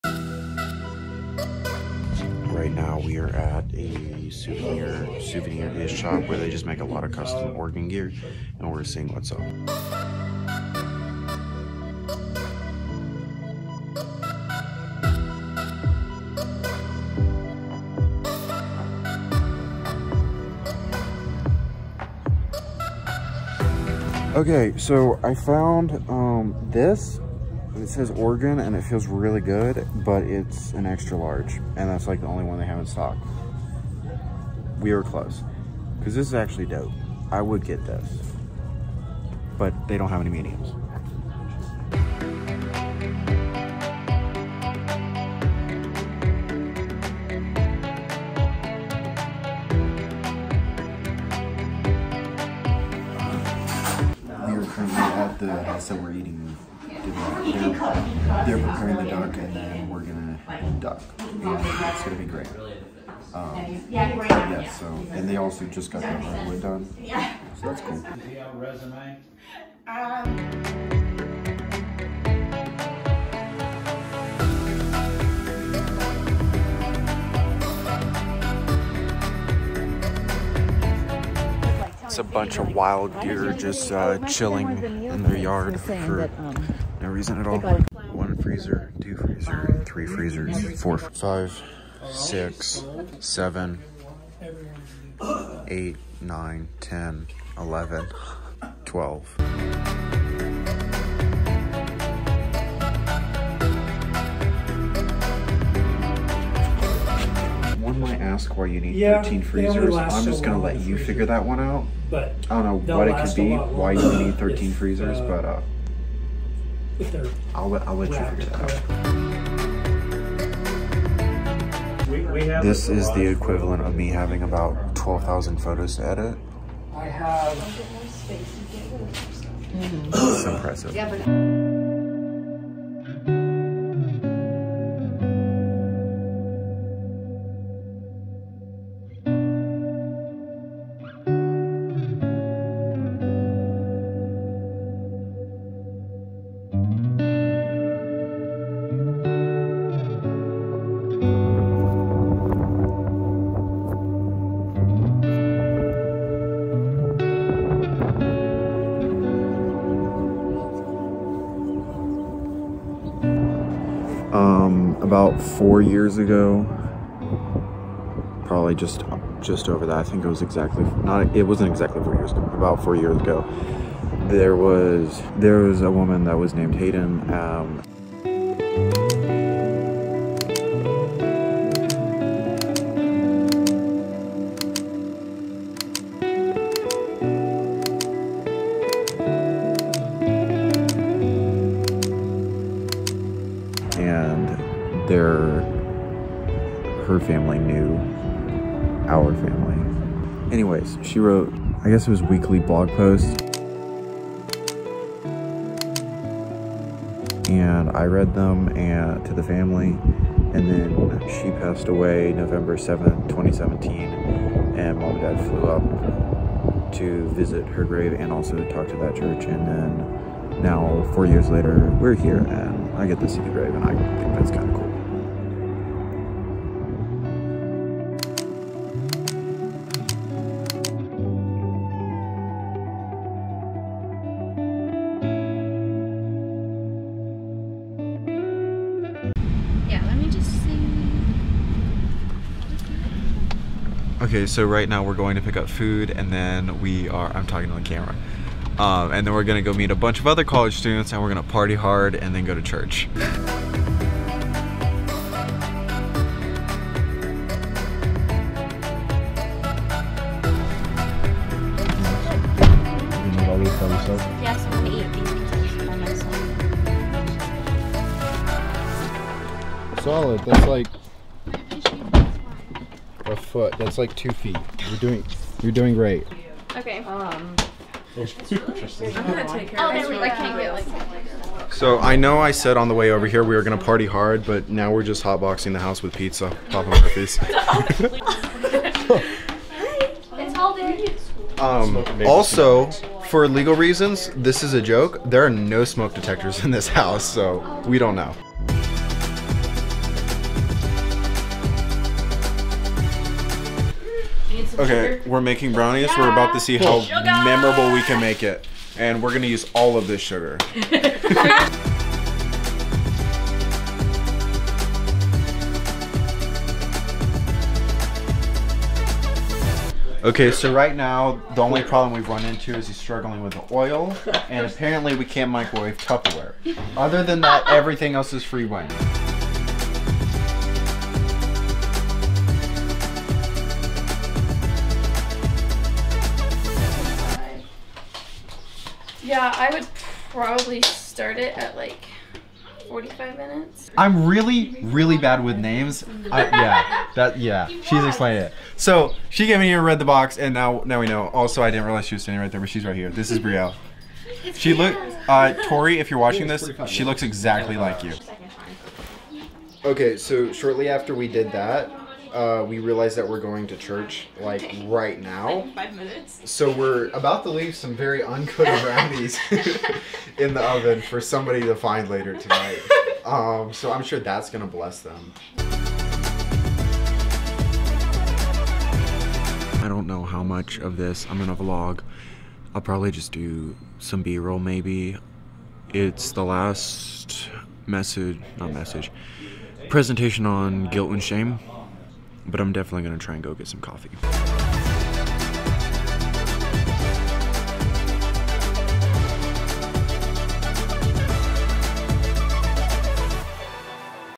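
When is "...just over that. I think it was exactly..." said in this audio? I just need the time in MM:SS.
02:49.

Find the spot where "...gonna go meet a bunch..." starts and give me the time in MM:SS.
04:09.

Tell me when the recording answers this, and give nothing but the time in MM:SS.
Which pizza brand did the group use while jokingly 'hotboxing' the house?
04:46.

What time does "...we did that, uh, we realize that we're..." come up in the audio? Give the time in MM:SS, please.
06:01.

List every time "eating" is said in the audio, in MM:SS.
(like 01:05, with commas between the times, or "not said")
00:56.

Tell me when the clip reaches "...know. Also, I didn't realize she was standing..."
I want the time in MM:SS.
05:51.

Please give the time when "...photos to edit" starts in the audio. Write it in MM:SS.
02:05.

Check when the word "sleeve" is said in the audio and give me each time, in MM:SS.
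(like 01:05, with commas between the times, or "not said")
not said.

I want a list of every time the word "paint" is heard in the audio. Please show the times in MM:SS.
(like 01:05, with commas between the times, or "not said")
not said.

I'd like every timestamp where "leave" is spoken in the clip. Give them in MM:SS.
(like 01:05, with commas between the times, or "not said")
06:07.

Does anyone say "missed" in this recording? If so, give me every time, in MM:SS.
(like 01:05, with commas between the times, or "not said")
not said.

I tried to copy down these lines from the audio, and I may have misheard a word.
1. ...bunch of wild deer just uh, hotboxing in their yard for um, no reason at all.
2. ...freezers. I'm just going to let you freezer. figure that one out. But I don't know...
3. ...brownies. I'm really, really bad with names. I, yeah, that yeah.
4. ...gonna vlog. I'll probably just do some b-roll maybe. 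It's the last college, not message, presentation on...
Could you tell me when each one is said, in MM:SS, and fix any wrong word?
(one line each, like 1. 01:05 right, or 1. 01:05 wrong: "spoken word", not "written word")
1. 01:22 wrong: "chilling", not "hotboxing"
2. 01:49 right
3. 05:43 wrong: "minutes", not "brownies"
4. 06:21 wrong: "message", not "college".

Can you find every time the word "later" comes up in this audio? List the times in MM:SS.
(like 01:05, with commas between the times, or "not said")
03:41, 06:12.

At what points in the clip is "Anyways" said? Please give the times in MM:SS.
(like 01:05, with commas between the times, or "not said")
03:20.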